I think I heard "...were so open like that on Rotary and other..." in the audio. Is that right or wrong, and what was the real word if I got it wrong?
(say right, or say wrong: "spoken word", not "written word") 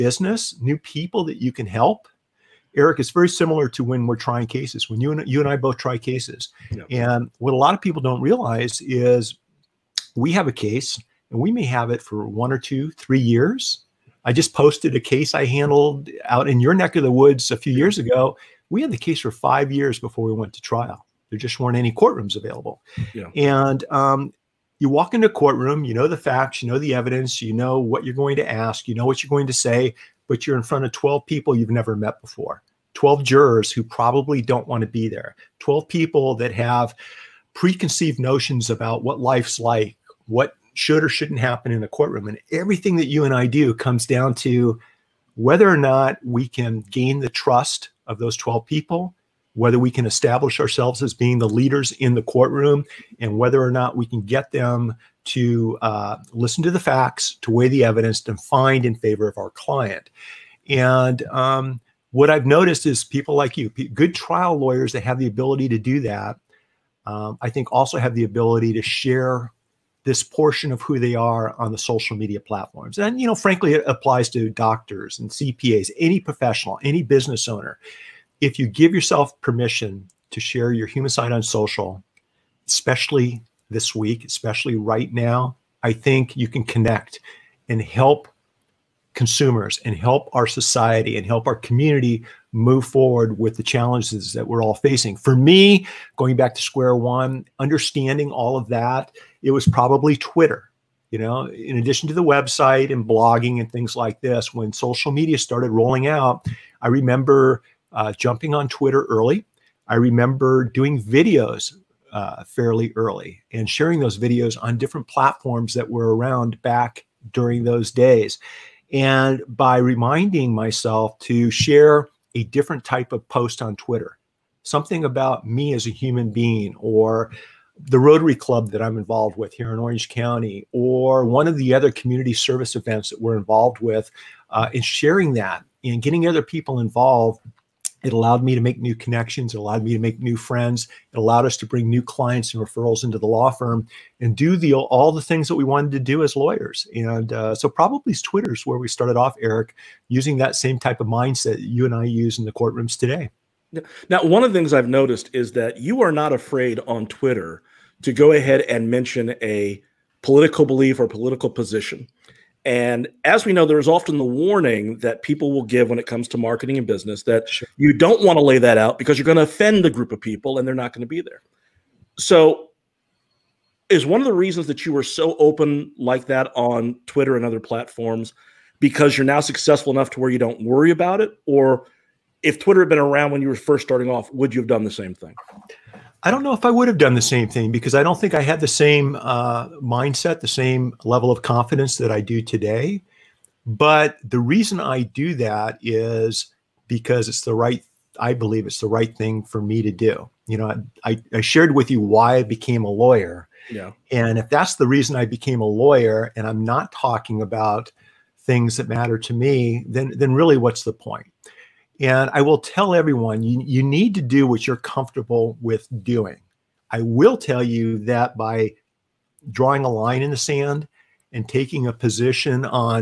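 wrong: "Twitter", not "Rotary".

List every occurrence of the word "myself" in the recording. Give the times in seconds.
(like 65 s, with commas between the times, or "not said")
120 s.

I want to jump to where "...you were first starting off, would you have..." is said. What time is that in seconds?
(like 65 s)
183 s.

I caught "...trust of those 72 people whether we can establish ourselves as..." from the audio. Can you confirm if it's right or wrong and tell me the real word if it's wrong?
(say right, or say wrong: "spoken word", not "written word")
wrong: "12", not "72".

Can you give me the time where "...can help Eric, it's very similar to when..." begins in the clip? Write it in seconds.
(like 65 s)
1 s.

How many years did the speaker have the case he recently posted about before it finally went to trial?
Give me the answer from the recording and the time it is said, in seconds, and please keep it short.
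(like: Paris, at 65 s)
5, at 19 s.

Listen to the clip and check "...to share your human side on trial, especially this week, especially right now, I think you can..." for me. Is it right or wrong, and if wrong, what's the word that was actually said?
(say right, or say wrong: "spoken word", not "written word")
wrong: "social", not "trial".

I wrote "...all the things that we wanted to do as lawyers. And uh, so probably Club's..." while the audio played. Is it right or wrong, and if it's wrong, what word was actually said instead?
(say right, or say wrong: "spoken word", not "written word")
wrong: "Twitter", not "Club".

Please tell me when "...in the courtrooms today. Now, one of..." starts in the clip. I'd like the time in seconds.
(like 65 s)
152 s.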